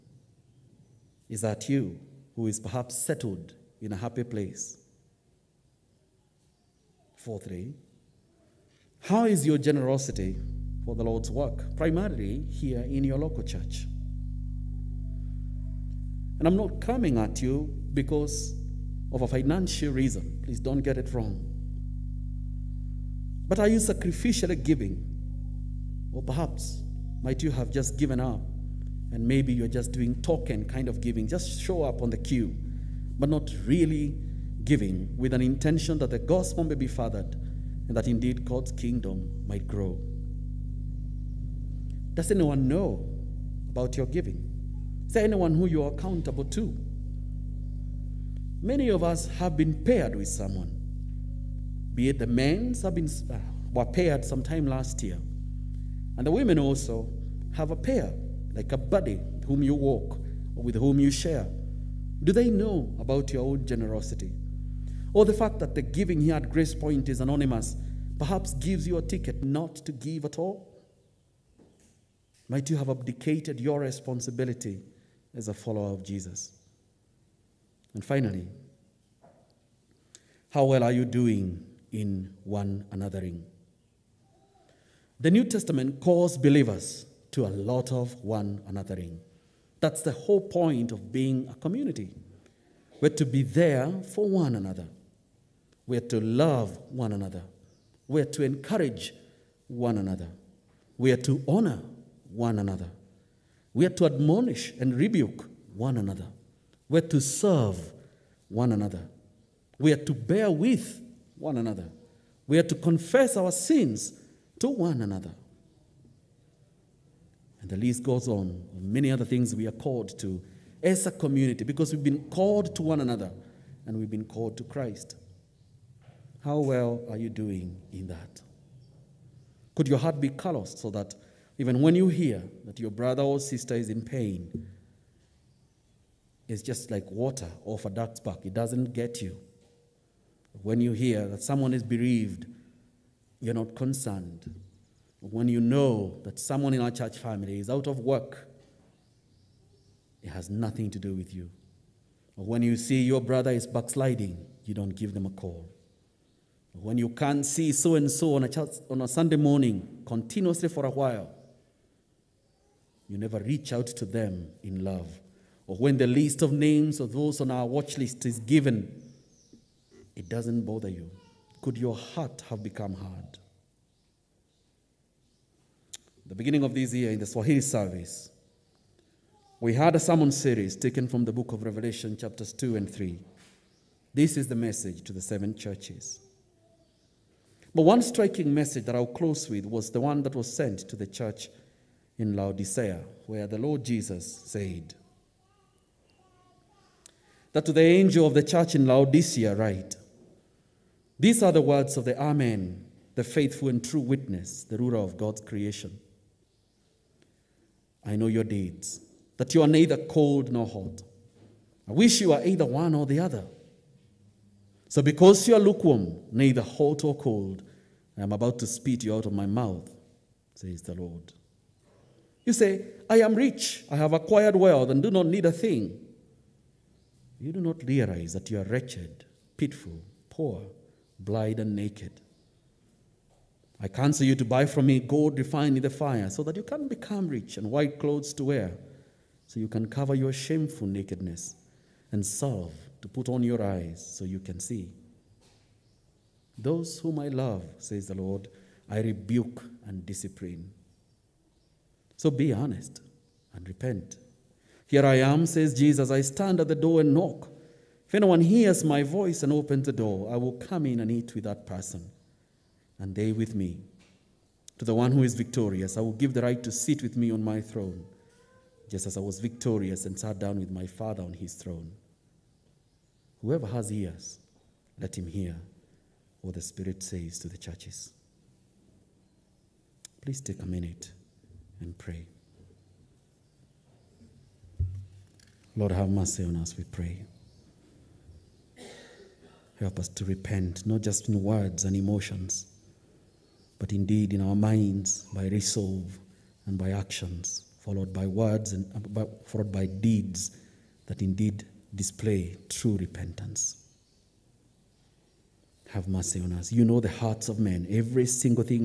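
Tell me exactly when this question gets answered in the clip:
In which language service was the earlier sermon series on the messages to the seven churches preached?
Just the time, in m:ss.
2:57.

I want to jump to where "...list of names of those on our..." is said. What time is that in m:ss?
2:46.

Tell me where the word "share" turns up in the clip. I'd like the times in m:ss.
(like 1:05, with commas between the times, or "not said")
1:01.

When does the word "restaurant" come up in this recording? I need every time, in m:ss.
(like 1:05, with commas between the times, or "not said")
not said.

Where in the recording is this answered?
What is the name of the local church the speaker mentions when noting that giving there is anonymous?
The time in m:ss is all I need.
1:06.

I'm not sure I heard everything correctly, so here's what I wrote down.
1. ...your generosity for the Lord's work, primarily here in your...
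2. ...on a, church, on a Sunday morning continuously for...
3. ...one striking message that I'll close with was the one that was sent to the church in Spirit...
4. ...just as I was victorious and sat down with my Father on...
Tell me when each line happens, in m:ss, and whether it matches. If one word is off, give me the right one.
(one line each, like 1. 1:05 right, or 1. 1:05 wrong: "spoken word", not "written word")
1. 0:09 right
2. 2:38 right
3. 3:07 wrong: "Laodicea", not "Spirit"
4. 4:28 right.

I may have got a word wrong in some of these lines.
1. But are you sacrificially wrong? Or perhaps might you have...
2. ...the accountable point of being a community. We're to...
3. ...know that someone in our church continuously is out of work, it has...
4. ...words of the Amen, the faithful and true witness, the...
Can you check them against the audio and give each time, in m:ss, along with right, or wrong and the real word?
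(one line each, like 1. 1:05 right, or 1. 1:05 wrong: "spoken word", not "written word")
1. 0:23 wrong: "giving", not "wrong"
2. 1:30 wrong: "whole", not "accountable"
3. 2:25 wrong: "family", not "continuously"
4. 3:21 right.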